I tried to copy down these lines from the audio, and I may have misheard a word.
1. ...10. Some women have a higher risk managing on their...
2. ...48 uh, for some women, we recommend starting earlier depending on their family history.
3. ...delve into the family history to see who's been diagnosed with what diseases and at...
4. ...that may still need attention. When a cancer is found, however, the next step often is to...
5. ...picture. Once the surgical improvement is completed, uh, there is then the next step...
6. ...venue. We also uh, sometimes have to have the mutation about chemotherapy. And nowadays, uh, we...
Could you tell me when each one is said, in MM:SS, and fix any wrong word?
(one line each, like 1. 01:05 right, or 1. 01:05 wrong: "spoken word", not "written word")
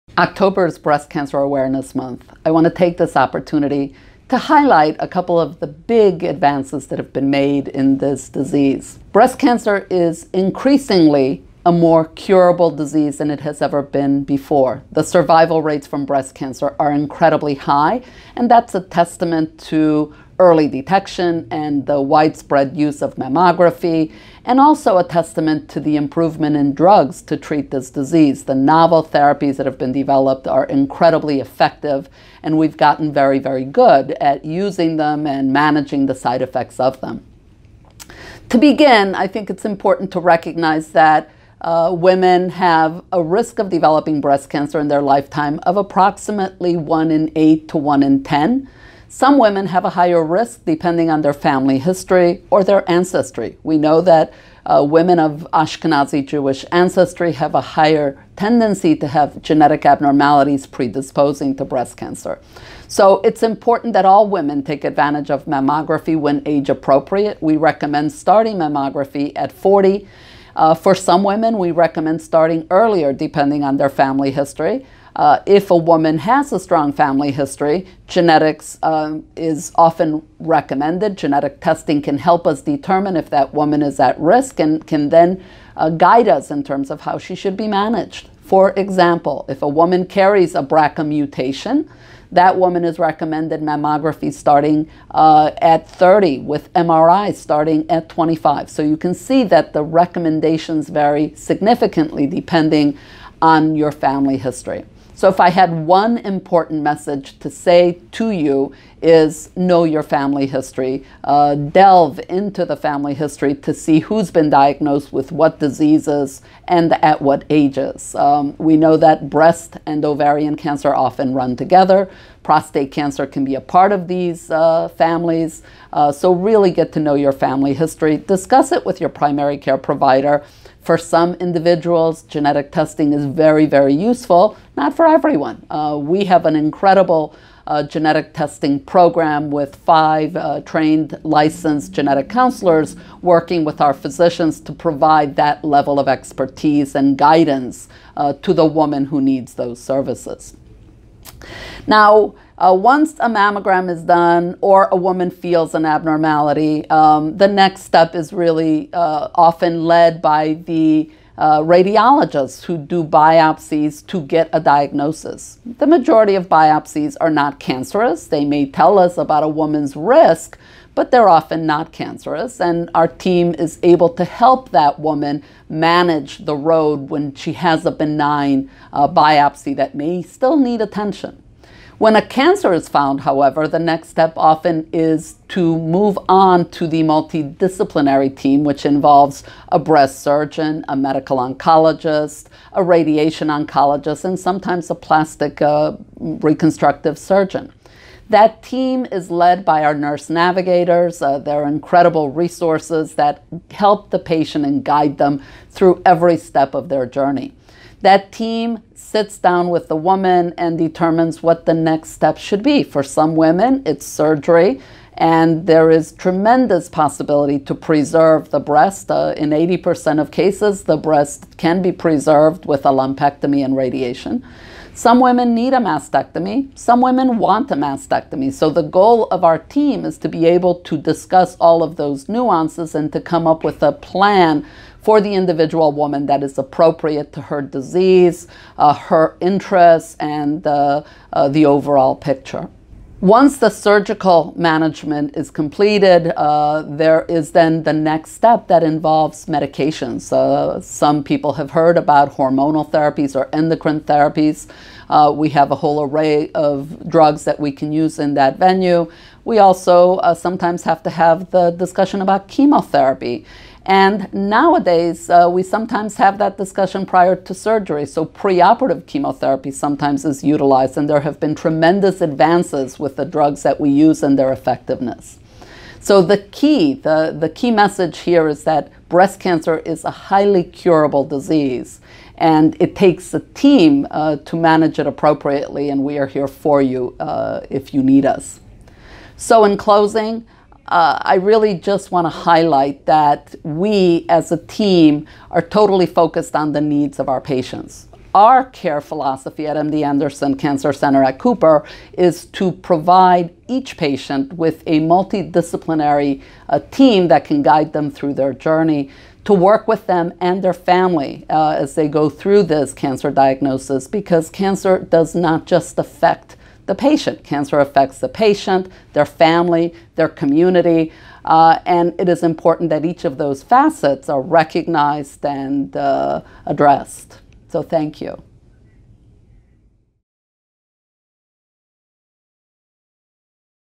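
1. 00:48 wrong: "depending", not "managing"
2. 01:09 wrong: "40", not "48"
3. 01:51 right
4. 02:59 right
5. 04:02 wrong: "management", not "improvement"
6. 04:18 wrong: "discussion", not "mutation".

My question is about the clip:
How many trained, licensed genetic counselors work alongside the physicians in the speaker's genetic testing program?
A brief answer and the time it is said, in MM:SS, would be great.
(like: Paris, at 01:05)
5, at 02:19.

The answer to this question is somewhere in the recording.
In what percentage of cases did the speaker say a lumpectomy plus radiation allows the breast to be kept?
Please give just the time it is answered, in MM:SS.
03:39.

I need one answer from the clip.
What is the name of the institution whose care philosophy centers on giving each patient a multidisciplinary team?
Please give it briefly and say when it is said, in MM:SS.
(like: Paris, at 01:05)
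MD Anderson Cancer Center at Cooper, at 04:59.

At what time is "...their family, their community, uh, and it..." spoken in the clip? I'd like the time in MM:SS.
05:19.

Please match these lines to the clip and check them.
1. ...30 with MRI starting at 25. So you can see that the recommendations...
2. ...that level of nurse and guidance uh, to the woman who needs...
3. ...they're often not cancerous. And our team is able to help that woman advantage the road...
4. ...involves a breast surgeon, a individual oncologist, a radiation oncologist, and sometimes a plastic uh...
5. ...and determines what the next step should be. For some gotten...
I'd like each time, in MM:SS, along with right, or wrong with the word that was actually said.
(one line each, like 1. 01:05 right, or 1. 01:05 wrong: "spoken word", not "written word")
1. 01:35 right
2. 02:25 wrong: "expertise", not "nurse"
3. 02:51 wrong: "manage", not "advantage"
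4. 03:08 wrong: "medical", not "individual"
5. 03:30 wrong: "women", not "gotten".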